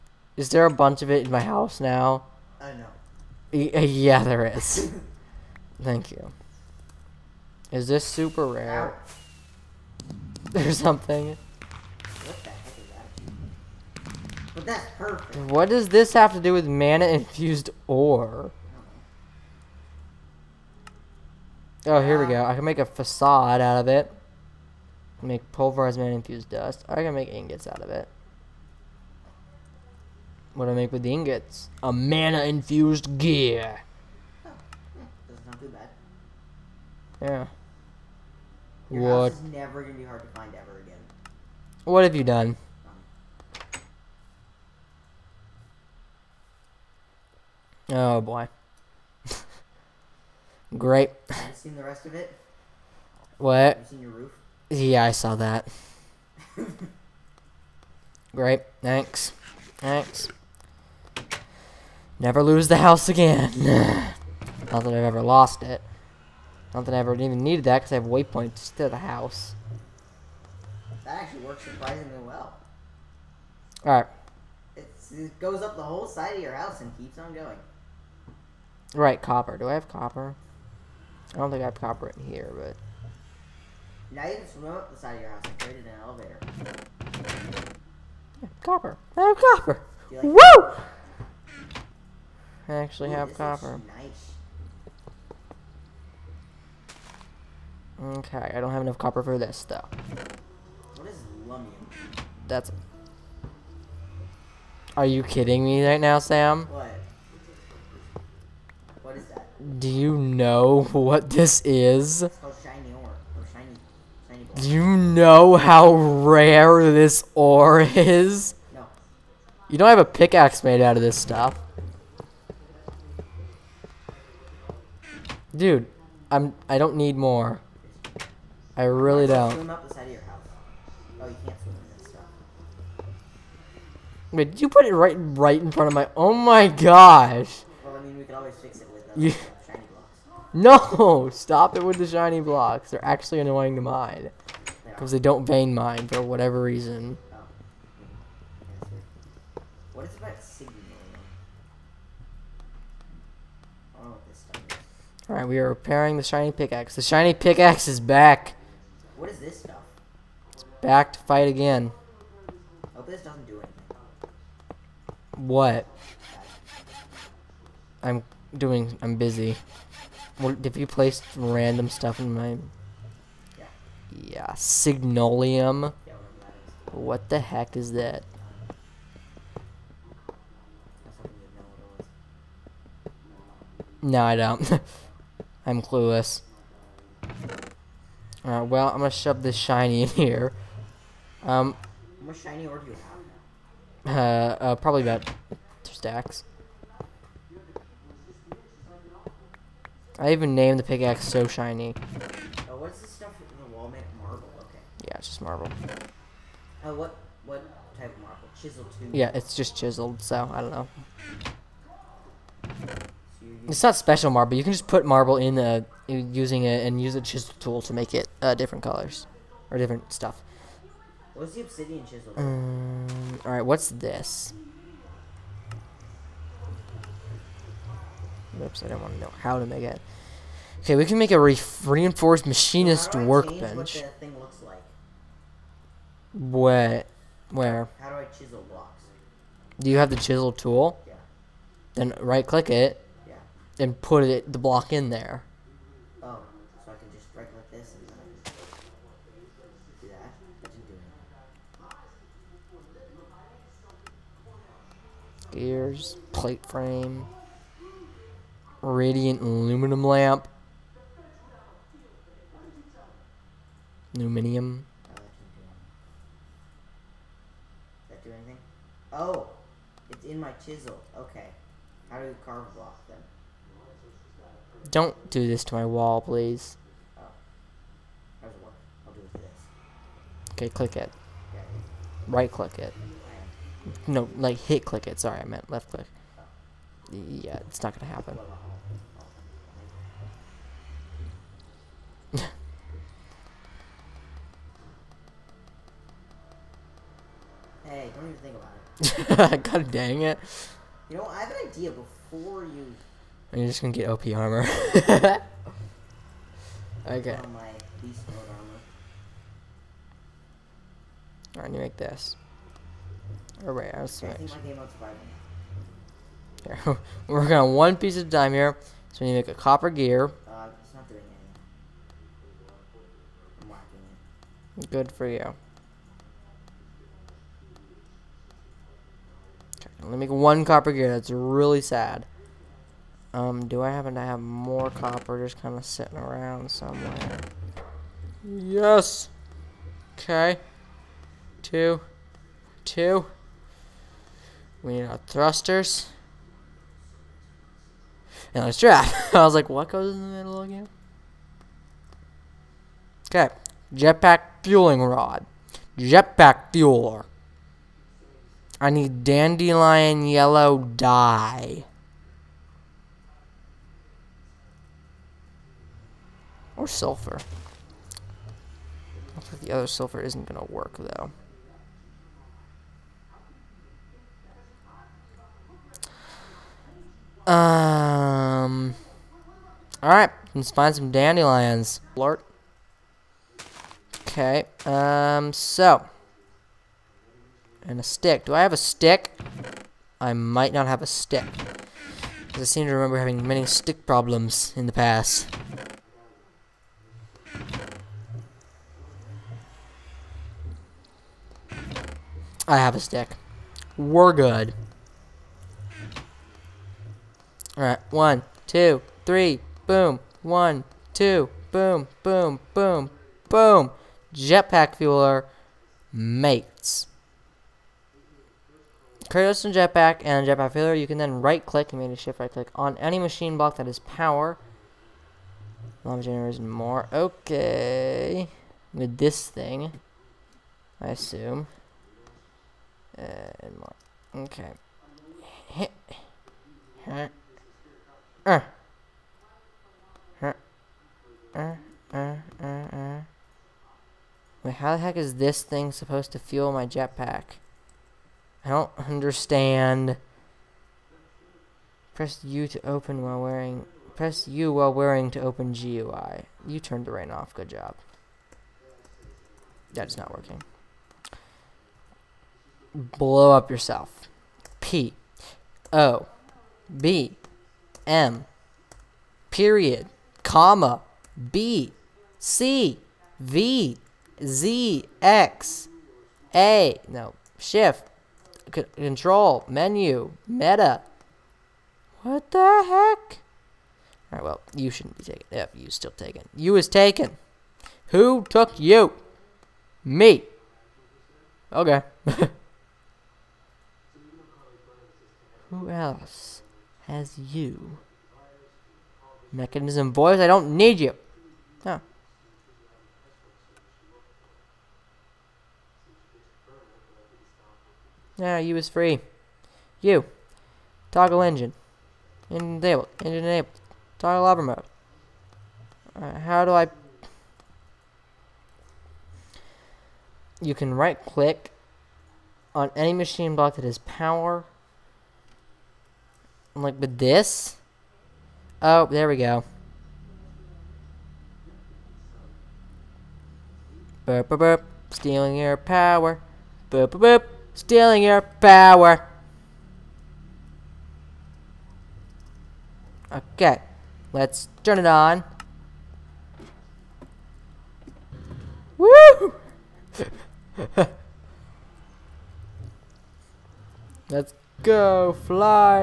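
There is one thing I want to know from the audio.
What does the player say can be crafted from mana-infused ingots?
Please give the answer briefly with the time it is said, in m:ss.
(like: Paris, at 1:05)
Mana-infused gear, at 0:31.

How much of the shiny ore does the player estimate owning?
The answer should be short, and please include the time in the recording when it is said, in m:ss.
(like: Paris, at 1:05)
About two stacks, at 3:15.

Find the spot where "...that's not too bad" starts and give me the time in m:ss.
0:35.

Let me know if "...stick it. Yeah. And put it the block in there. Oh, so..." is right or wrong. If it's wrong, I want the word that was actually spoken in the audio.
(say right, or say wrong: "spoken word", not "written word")
wrong: "click", not "stick".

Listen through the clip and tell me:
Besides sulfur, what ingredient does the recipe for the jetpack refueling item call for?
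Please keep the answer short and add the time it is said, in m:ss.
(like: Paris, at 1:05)
Dandelion yellow dye, at 5:59.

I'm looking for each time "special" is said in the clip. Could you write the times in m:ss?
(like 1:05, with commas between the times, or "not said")
3:33.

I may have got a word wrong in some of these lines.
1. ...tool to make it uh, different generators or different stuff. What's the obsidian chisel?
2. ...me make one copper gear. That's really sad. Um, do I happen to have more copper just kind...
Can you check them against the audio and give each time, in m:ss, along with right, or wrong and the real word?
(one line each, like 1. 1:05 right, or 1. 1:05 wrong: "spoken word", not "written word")
1. 3:37 wrong: "colors", not "generators"
2. 5:30 right.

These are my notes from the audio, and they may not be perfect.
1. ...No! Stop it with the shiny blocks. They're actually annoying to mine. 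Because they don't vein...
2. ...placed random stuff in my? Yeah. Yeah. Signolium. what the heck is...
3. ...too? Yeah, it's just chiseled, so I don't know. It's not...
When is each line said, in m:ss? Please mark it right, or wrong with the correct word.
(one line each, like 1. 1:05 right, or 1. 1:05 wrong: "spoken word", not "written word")
1. 2:20 right
2. 2:50 right
3. 3:28 right.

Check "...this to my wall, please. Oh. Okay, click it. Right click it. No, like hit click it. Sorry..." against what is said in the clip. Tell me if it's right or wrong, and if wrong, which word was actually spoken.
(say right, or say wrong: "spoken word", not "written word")
right.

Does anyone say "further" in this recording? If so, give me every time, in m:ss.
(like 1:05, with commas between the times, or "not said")
not said.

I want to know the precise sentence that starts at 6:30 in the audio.
I might not have a stick.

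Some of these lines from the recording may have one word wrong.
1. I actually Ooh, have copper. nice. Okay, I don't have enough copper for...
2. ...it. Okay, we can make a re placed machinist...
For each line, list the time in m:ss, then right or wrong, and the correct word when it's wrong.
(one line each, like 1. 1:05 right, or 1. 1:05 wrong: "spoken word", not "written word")
1. 1:32 right
2. 3:49 wrong: "reinforced", not "placed".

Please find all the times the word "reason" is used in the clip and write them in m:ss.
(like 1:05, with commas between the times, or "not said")
2:26.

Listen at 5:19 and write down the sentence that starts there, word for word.
So we need to make a copper gear.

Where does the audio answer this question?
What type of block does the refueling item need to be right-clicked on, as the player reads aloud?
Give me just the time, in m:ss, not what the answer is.
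8:43.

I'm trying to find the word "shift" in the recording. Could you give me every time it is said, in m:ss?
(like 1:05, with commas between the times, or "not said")
7:02, 7:57.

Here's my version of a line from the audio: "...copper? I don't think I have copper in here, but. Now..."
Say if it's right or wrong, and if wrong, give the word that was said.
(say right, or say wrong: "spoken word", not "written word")
right.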